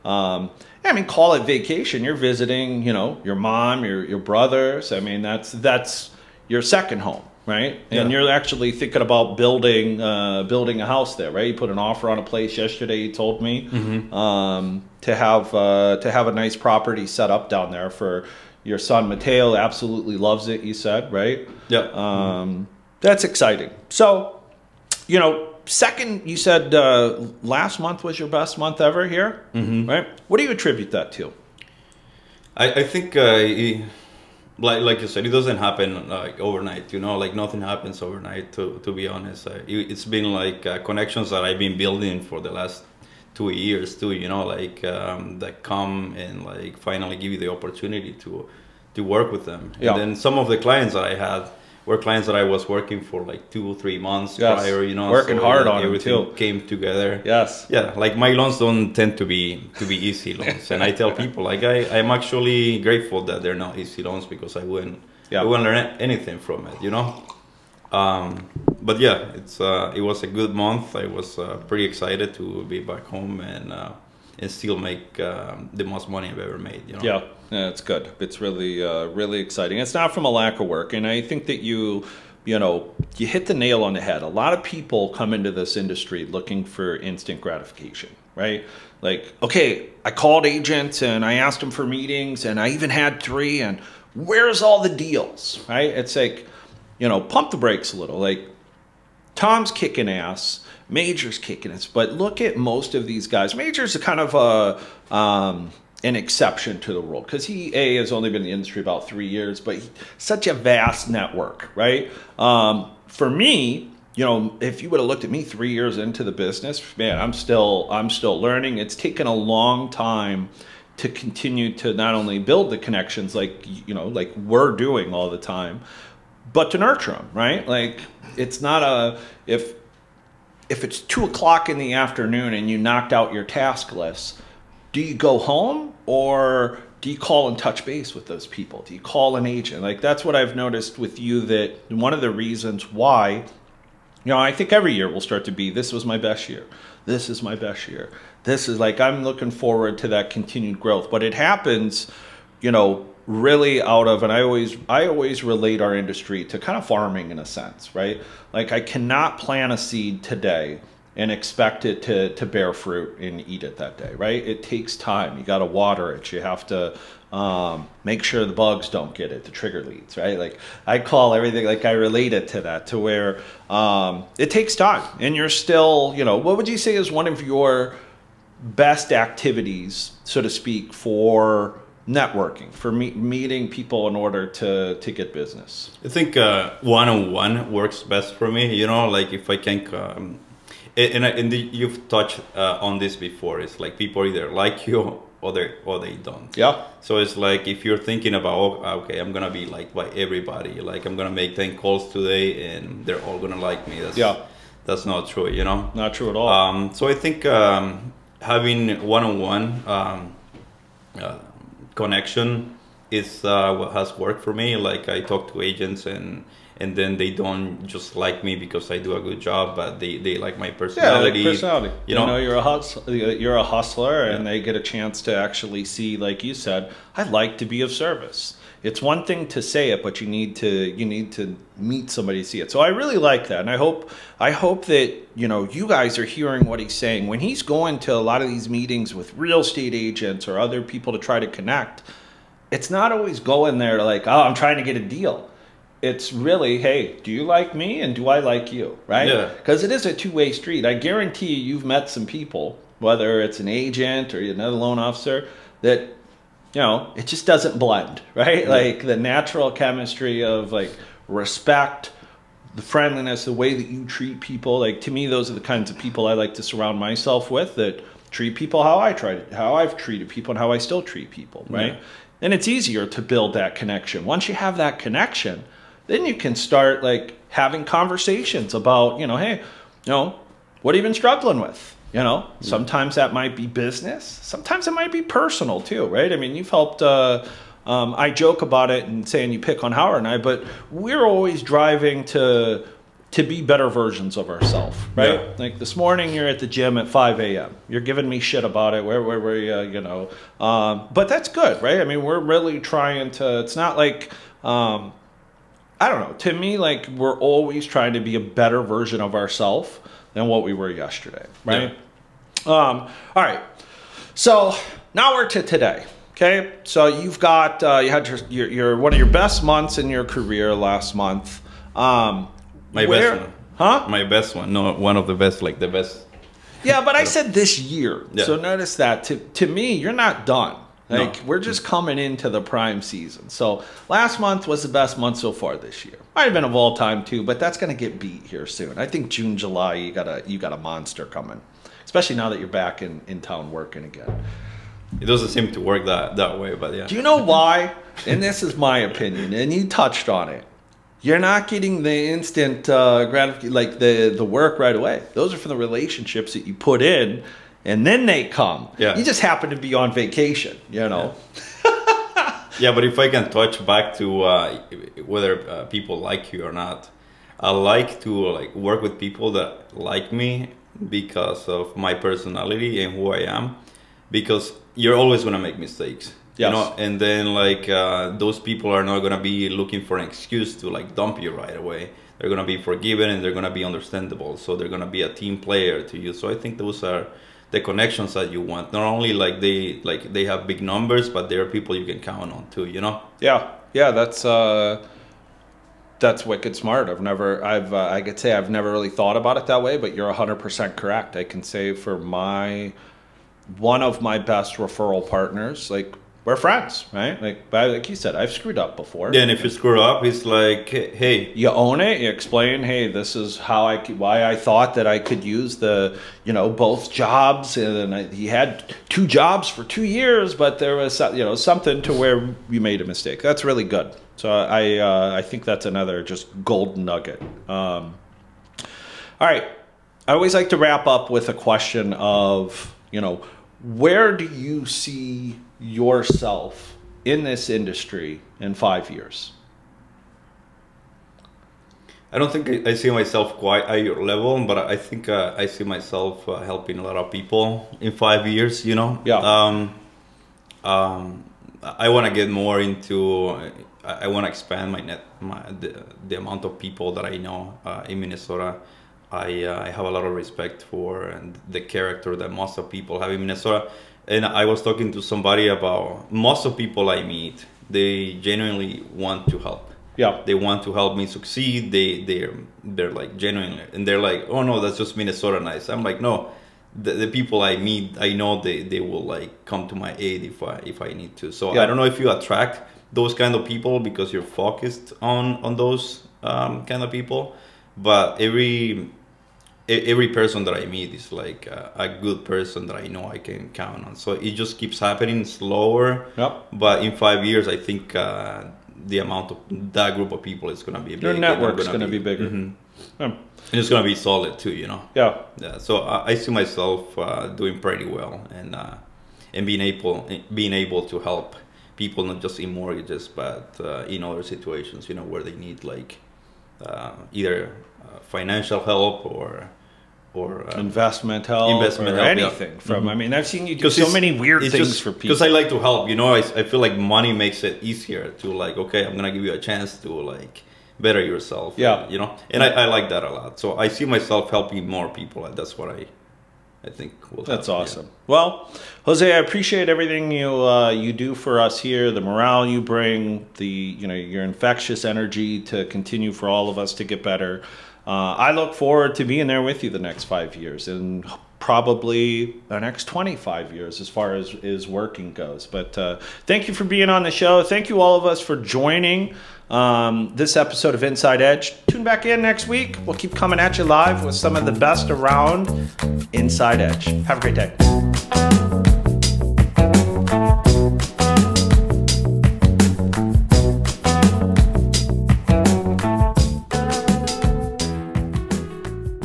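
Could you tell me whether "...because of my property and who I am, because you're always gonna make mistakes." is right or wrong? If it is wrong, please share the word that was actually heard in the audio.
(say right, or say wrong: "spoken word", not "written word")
wrong: "personality", not "property".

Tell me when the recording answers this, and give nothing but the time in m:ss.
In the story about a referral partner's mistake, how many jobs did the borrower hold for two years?
6:59.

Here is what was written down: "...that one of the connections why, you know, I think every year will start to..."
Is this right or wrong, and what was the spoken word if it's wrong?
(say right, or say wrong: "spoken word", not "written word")
wrong: "reasons", not "connections".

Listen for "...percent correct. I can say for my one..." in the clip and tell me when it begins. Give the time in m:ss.
6:40.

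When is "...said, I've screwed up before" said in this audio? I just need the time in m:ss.
6:48.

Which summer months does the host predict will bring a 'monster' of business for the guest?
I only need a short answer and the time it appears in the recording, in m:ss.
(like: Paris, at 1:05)
June, July, at 5:39.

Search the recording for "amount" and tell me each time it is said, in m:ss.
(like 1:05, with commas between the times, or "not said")
7:36, 8:19.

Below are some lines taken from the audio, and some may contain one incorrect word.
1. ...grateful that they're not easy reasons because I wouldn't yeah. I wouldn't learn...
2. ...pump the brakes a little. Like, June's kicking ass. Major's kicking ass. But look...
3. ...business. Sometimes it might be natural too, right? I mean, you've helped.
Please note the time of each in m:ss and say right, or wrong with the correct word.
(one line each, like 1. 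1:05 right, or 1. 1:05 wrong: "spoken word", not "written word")
1. 1:02 wrong: "loans", not "reasons"
2. 1:37 wrong: "Tom", not "June"
3. 4:43 wrong: "personal", not "natural".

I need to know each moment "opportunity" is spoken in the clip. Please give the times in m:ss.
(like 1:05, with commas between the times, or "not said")
0:47.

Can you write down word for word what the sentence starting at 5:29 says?
To to me, you're not done.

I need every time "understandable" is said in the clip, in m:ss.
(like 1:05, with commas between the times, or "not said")
6:23.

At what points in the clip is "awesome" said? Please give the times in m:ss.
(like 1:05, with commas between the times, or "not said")
8:57.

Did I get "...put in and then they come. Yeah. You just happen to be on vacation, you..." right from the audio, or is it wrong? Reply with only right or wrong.
right.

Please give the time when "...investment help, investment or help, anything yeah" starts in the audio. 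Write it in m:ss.
8:40.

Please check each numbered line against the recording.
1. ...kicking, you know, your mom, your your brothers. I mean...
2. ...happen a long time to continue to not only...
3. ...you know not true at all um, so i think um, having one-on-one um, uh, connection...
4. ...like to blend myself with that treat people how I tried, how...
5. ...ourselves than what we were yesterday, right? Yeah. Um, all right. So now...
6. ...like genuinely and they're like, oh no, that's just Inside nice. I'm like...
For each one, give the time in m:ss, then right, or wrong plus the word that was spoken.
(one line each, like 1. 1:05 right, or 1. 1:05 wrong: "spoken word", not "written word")
1. 0:02 wrong: "visiting", not "kicking"
2. 1:58 wrong: "taken", not "happen"
3. 3:25 right
4. 4:26 wrong: "surround", not "blend"
5. 5:09 right
6. 7:53 wrong: "Minnesota", not "Inside".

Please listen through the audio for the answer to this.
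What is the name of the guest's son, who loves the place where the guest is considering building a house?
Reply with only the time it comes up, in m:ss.
0:19.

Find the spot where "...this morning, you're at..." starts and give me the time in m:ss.
4:55.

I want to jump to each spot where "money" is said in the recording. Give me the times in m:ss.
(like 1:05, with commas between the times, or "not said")
1:16, 8:46.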